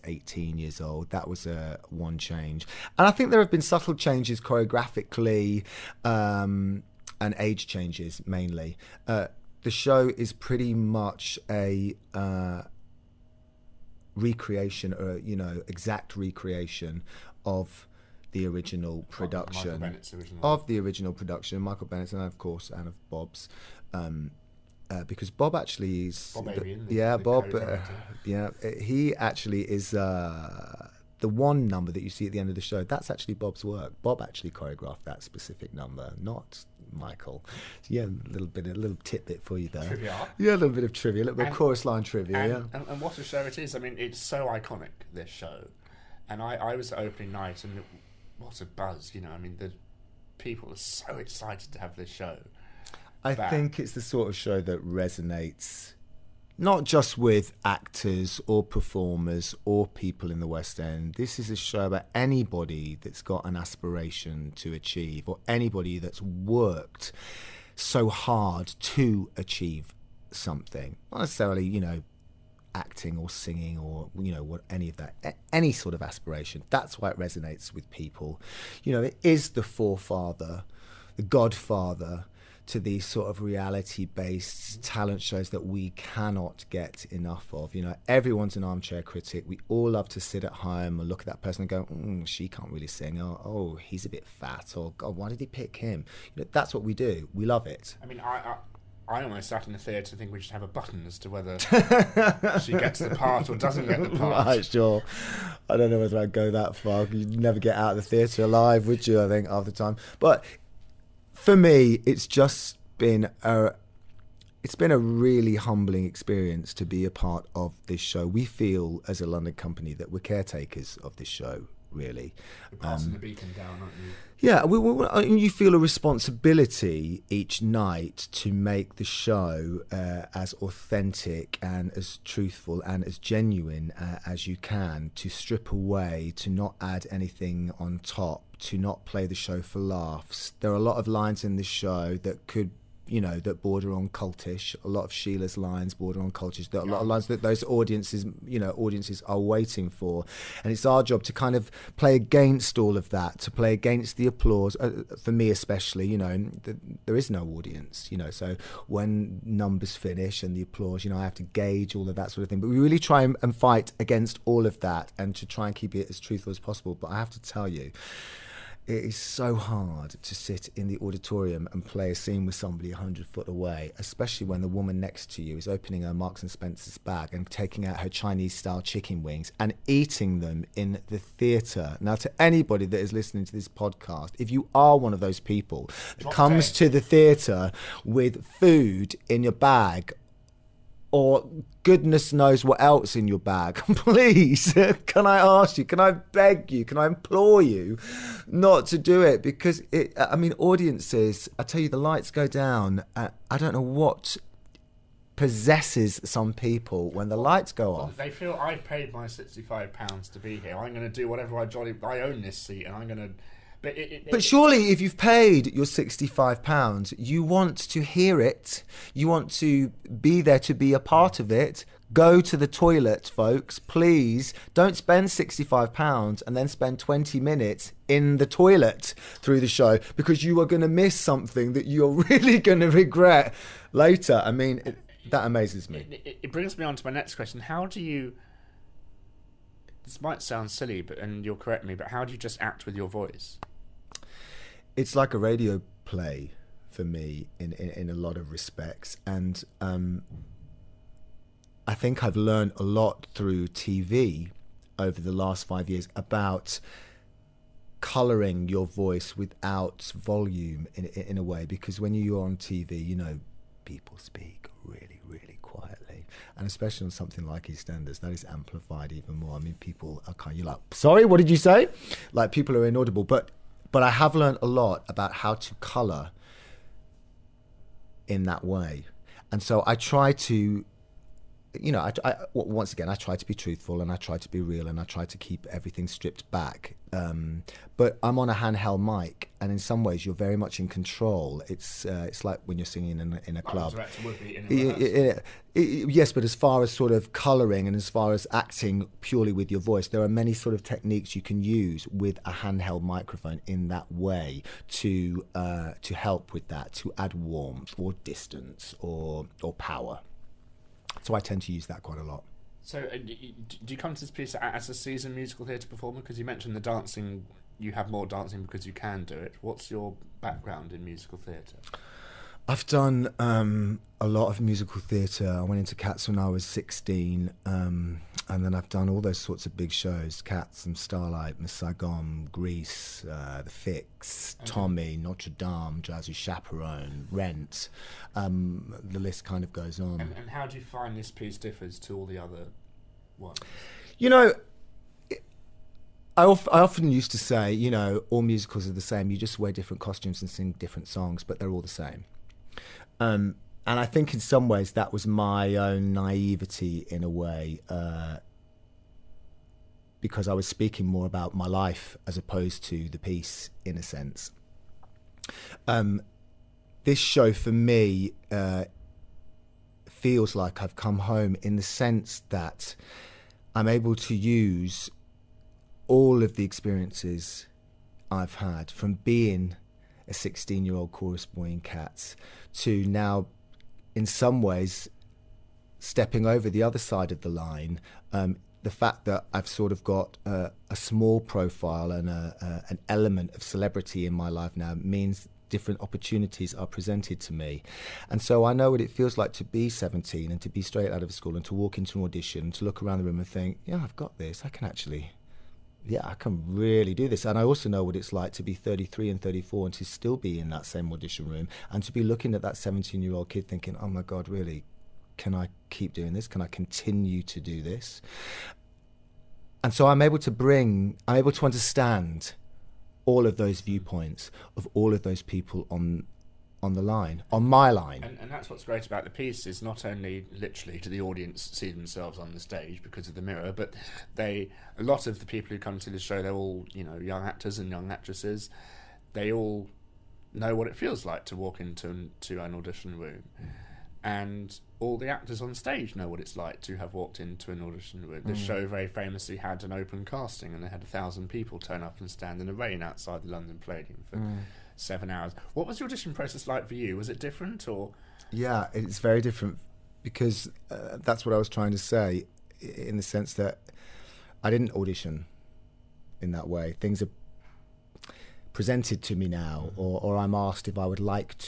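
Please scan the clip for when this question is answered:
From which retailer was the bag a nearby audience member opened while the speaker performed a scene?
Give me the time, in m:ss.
2:56.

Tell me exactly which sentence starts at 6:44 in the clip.
I can actually yeah, I can really do this.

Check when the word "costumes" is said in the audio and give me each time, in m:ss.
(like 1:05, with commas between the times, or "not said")
5:50.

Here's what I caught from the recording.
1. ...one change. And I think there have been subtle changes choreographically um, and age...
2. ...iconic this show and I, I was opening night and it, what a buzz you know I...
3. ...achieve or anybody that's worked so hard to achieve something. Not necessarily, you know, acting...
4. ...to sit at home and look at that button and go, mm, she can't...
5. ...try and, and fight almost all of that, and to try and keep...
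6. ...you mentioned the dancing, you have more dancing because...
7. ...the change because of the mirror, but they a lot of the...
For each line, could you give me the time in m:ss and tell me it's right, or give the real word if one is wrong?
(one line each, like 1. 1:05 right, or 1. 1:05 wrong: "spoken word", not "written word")
1. 0:01 right
2. 0:44 right
3. 1:04 right
4. 1:30 wrong: "person", not "button"
5. 2:42 wrong: "against", not "almost"
6. 5:16 right
7. 7:12 wrong: "stage", not "change".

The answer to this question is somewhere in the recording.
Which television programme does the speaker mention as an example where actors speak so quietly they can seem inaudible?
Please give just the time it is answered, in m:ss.
4:27.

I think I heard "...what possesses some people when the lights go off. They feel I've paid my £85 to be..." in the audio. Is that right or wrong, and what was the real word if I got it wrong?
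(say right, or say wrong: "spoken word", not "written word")
wrong: "65", not "85".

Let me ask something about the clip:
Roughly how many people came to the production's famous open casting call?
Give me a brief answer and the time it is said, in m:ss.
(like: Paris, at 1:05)
1000, at 7:31.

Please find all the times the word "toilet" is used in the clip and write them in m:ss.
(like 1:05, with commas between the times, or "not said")
3:42, 3:48.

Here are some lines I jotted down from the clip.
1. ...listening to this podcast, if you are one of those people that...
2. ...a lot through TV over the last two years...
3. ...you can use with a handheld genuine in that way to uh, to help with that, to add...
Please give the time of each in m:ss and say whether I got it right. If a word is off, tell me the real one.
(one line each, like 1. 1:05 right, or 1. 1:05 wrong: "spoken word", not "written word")
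1. 3:03 right
2. 4:12 wrong: "five", not "two"
3. 5:01 wrong: "microphone", not "genuine".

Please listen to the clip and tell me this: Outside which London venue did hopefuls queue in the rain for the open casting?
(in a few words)
London Palladium.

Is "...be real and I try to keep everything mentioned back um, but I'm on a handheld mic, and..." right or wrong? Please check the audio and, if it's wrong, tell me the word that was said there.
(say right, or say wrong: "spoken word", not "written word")
wrong: "stripped", not "mentioned".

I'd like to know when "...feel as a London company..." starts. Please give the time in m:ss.
1:58.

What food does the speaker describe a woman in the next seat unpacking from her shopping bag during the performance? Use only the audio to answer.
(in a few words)
Chinese style chicken wings.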